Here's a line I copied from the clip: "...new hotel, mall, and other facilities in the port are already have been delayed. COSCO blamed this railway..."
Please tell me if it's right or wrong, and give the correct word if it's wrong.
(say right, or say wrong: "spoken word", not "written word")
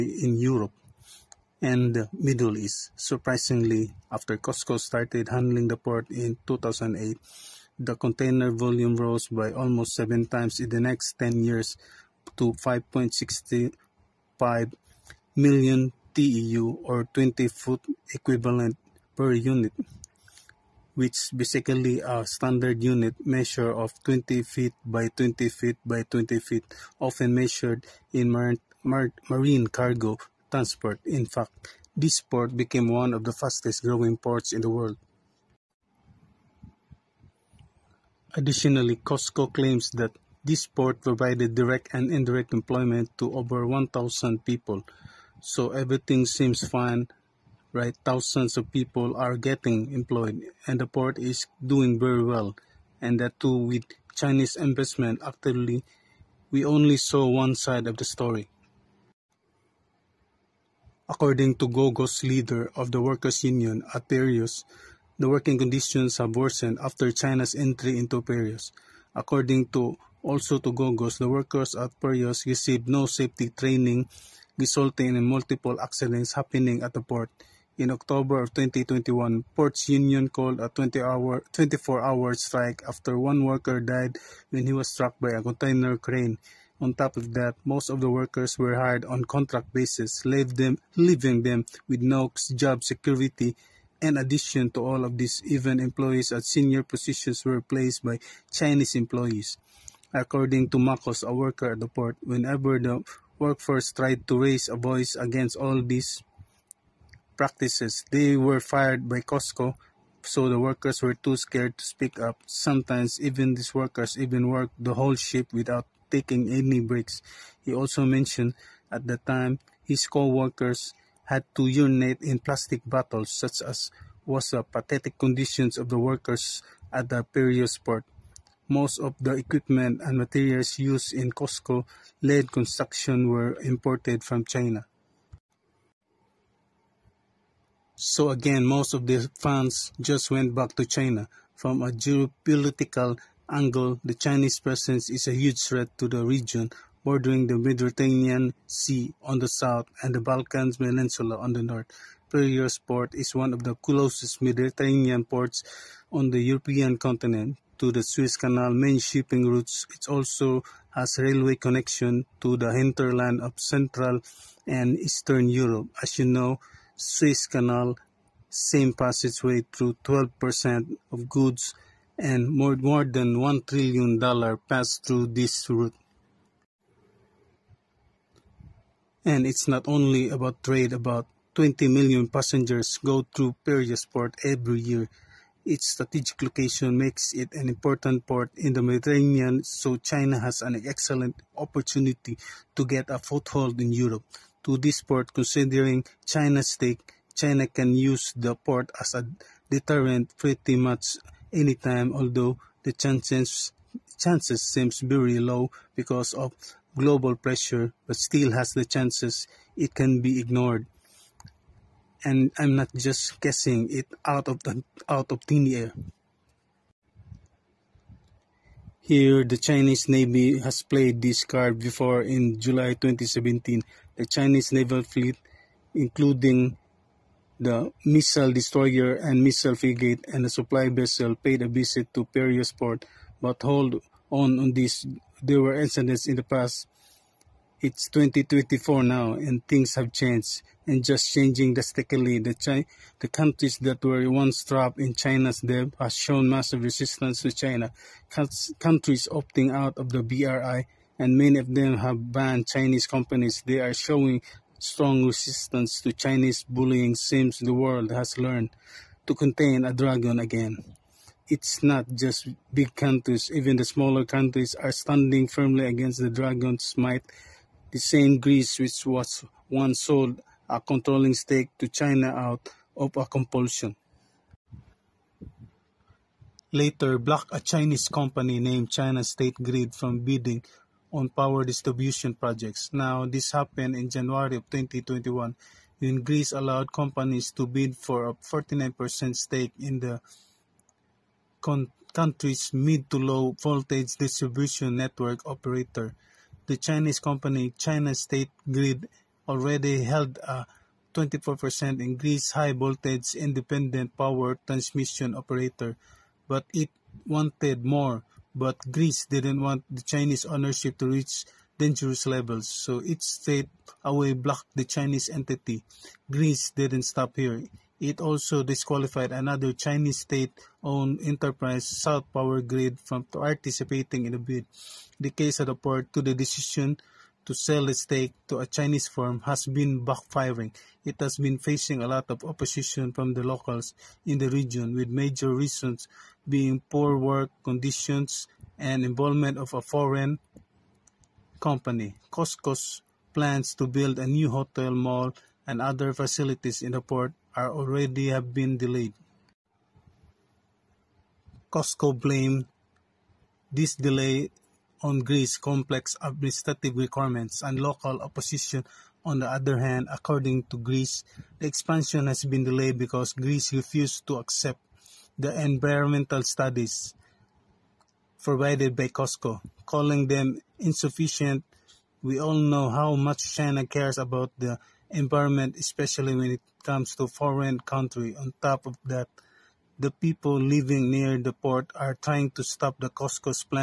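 wrong: "delay", not "railway".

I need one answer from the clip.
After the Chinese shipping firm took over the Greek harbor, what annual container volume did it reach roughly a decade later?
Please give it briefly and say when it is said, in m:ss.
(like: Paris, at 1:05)
5.65 million TEU, at 0:12.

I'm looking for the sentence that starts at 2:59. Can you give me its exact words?
And it's not only about trade, about 20 million passengers go through Piraeus port every year.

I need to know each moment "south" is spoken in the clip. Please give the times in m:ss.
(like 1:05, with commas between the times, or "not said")
2:29, 5:21.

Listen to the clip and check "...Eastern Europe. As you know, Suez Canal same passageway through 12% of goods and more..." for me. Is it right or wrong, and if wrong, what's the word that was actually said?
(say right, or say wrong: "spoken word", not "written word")
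right.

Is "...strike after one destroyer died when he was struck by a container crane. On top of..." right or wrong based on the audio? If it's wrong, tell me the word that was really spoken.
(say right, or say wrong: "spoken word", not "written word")
wrong: "worker", not "destroyer".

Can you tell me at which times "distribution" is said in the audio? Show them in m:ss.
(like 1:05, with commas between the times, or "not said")
4:41, 4:54.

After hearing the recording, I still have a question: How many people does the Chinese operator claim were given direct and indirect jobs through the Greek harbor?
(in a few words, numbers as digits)
over 1,000.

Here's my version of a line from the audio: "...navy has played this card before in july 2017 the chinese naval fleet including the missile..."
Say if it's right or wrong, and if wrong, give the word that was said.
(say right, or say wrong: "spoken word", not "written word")
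right.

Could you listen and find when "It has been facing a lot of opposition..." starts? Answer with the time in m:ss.
5:31.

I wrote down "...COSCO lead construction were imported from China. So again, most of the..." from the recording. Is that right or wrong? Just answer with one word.
right.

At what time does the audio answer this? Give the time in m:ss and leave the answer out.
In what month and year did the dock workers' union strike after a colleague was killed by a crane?
1:17.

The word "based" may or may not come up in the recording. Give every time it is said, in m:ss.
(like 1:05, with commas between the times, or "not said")
not said.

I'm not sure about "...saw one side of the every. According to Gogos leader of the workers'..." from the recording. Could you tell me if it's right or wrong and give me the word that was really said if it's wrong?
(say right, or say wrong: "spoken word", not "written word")
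wrong: "story", not "every".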